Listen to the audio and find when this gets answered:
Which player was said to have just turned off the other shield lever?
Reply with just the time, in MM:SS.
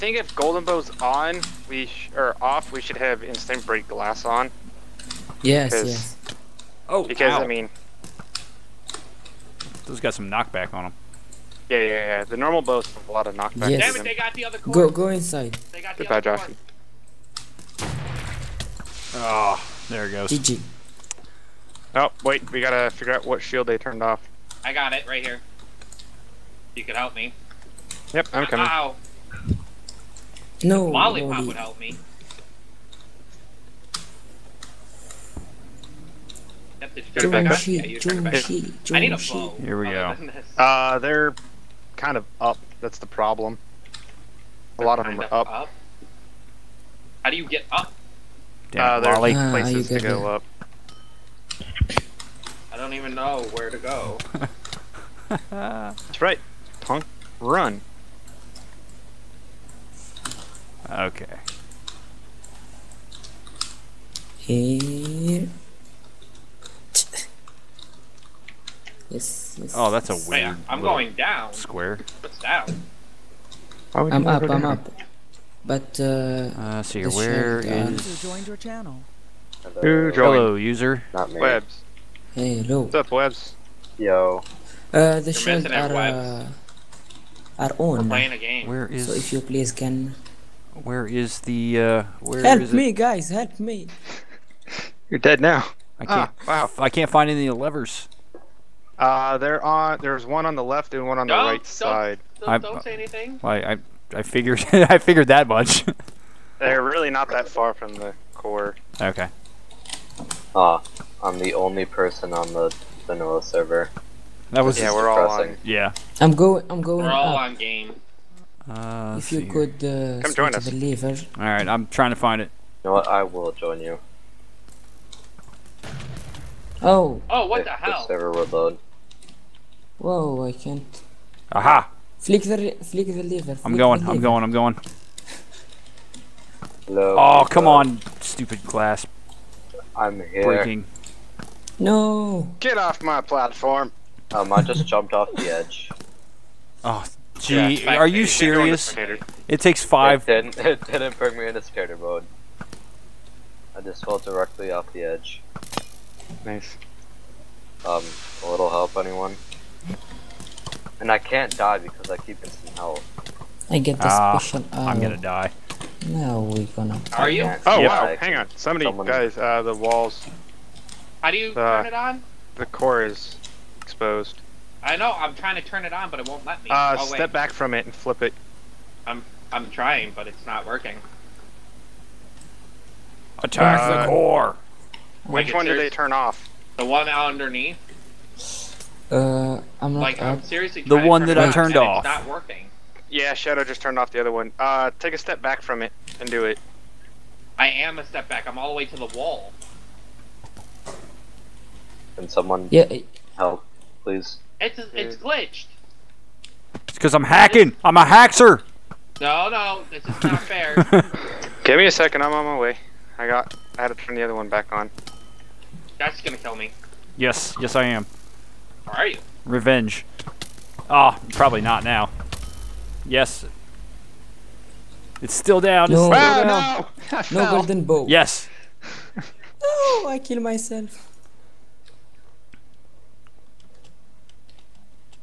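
03:13.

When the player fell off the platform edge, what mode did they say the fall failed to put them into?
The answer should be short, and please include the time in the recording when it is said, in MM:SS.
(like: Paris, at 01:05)
skater mode, at 02:31.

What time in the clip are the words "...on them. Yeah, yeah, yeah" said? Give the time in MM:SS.
00:10.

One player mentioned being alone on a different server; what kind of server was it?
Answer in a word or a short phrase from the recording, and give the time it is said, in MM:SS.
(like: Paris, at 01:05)
vanilla, at 01:53.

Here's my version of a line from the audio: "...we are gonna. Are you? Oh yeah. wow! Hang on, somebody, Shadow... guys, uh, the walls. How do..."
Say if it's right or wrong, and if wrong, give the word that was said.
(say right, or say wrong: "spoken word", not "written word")
wrong: "Someone", not "Shadow".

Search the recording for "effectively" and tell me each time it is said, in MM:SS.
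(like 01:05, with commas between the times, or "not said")
not said.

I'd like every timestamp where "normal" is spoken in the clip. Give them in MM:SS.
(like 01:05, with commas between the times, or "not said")
00:12.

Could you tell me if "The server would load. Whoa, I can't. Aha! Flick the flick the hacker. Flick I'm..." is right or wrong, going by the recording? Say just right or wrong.
wrong.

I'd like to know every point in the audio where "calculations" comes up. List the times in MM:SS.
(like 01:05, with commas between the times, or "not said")
not said.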